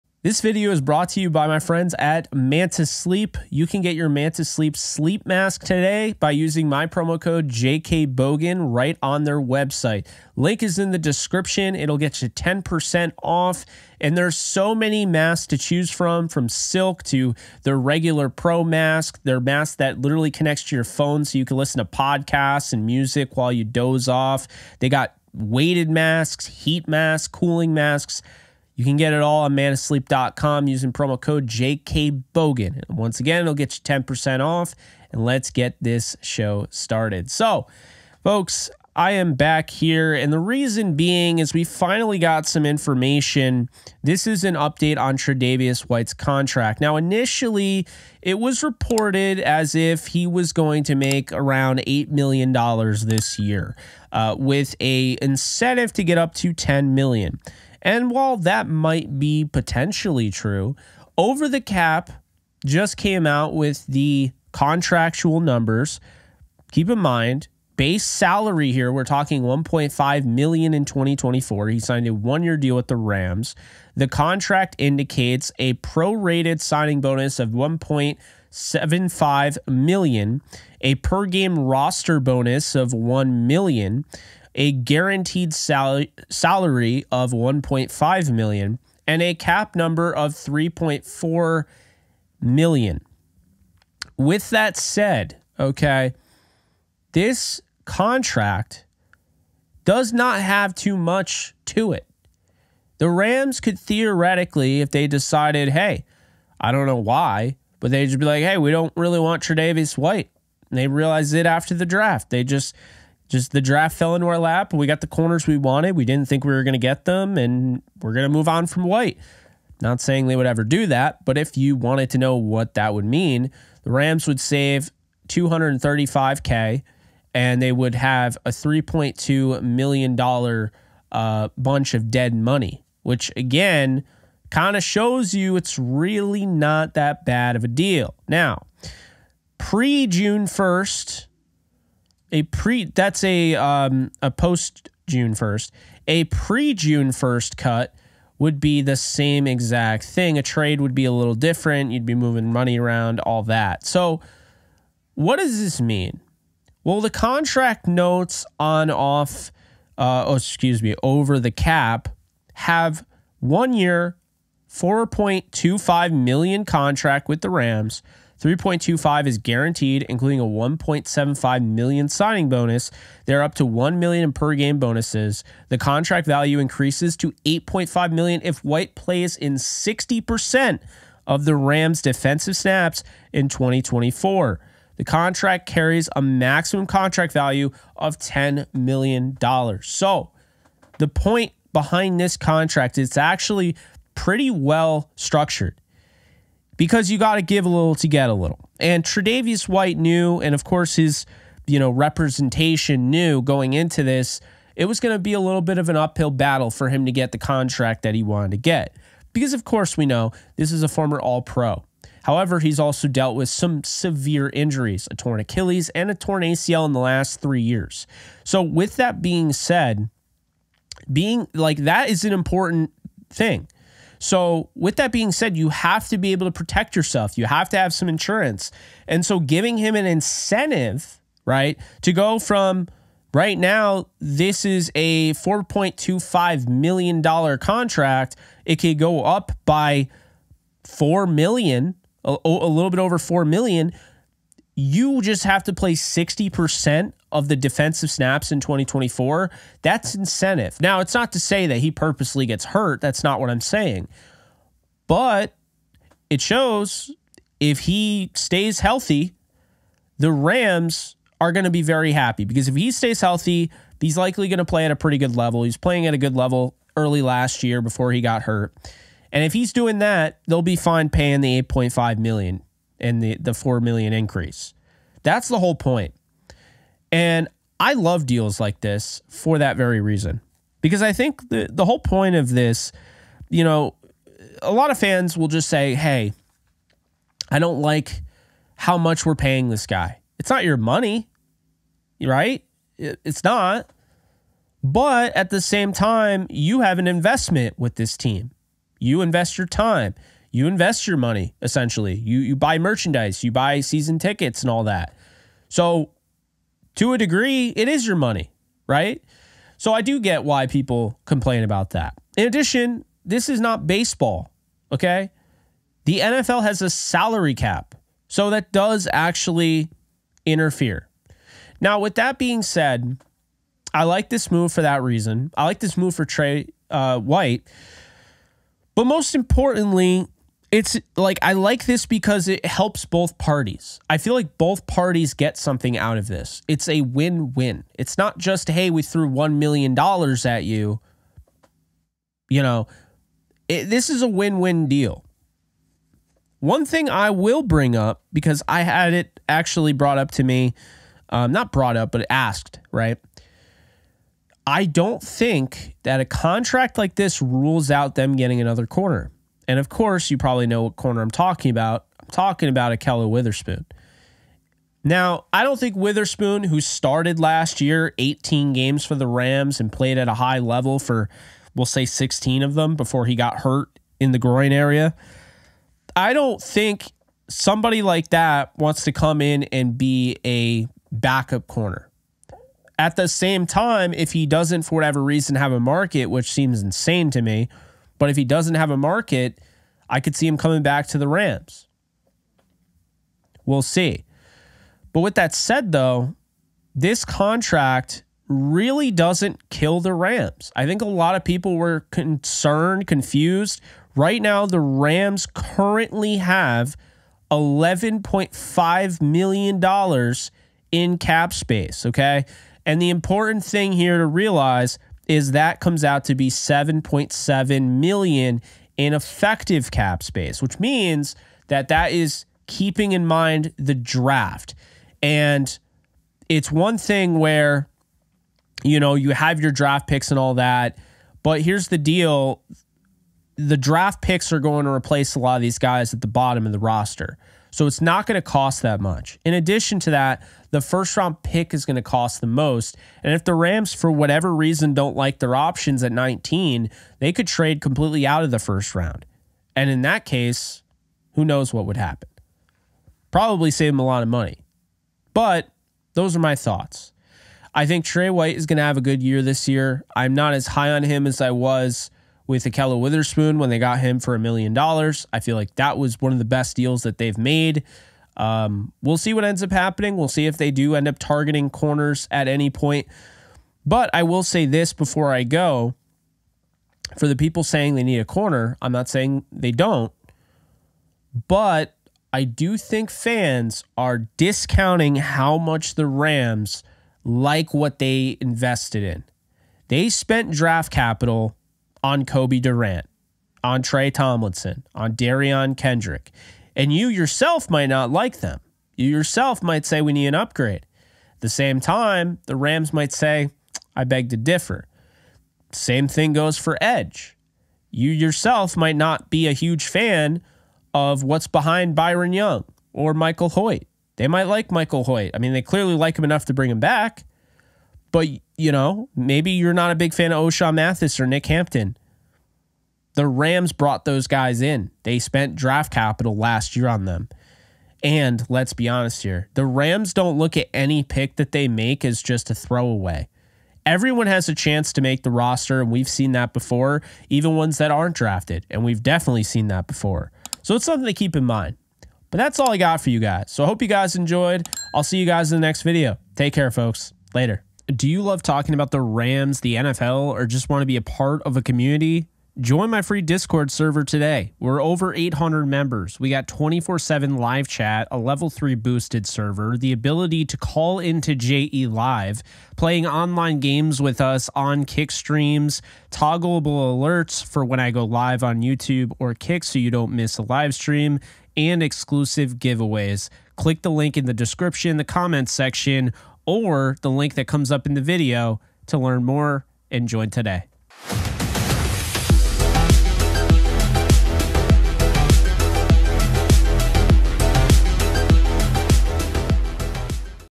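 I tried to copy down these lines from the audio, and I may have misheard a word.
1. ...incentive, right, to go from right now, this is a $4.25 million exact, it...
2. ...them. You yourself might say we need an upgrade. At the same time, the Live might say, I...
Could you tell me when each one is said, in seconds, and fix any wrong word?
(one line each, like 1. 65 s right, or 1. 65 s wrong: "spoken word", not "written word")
1. 230 s wrong: "contract", not "exact"
2. 498 s wrong: "Rams", not "Live".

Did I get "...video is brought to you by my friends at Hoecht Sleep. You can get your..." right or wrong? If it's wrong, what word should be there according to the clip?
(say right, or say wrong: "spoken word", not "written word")
wrong: "Manta", not "Hoecht".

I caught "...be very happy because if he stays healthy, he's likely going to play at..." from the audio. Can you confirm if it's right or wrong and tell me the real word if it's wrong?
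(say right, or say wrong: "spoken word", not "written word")
right.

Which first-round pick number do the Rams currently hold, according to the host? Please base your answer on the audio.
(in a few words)
19.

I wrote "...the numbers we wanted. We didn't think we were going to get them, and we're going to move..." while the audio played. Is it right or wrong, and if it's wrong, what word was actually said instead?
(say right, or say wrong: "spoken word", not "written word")
wrong: "corners", not "numbers".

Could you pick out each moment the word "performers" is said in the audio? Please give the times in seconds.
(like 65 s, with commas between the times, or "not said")
not said.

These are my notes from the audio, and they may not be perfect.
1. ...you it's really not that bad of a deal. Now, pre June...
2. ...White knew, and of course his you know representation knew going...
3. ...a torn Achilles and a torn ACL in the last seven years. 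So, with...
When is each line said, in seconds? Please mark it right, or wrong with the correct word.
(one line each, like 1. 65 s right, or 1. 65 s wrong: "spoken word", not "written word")
1. 135 s right
2. 199 s right
3. 215 s wrong: "three", not "seven".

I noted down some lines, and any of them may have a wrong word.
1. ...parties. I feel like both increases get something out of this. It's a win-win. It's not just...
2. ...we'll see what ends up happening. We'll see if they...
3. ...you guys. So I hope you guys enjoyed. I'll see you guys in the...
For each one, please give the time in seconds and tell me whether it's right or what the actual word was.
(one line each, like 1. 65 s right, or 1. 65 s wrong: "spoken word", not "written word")
1. 333 s wrong: "parties", not "increases"
2. 469 s right
3. 543 s right.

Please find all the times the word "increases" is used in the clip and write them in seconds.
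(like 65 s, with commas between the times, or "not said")
176 s, 274 s.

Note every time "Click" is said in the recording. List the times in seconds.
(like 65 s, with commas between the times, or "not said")
573 s.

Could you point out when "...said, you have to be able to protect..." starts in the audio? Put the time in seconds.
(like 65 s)
225 s.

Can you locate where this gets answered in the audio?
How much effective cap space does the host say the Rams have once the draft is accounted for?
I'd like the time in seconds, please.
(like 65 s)
416 s.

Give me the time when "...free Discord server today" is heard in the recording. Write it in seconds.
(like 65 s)
553 s.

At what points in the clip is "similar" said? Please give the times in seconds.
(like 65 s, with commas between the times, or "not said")
not said.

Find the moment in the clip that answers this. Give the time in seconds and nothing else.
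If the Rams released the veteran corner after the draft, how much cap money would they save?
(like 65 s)
125 s.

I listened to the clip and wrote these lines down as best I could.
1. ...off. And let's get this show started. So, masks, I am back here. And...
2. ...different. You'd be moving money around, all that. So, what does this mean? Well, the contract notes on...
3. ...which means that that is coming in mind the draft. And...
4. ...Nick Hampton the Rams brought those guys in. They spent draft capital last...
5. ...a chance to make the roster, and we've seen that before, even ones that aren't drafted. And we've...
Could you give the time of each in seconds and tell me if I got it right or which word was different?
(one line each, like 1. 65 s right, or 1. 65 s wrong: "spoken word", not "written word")
1. 34 s wrong: "folks", not "masks"
2. 151 s right
3. 420 s wrong: "keeping", not "coming"
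4. 521 s right
5. 534 s right.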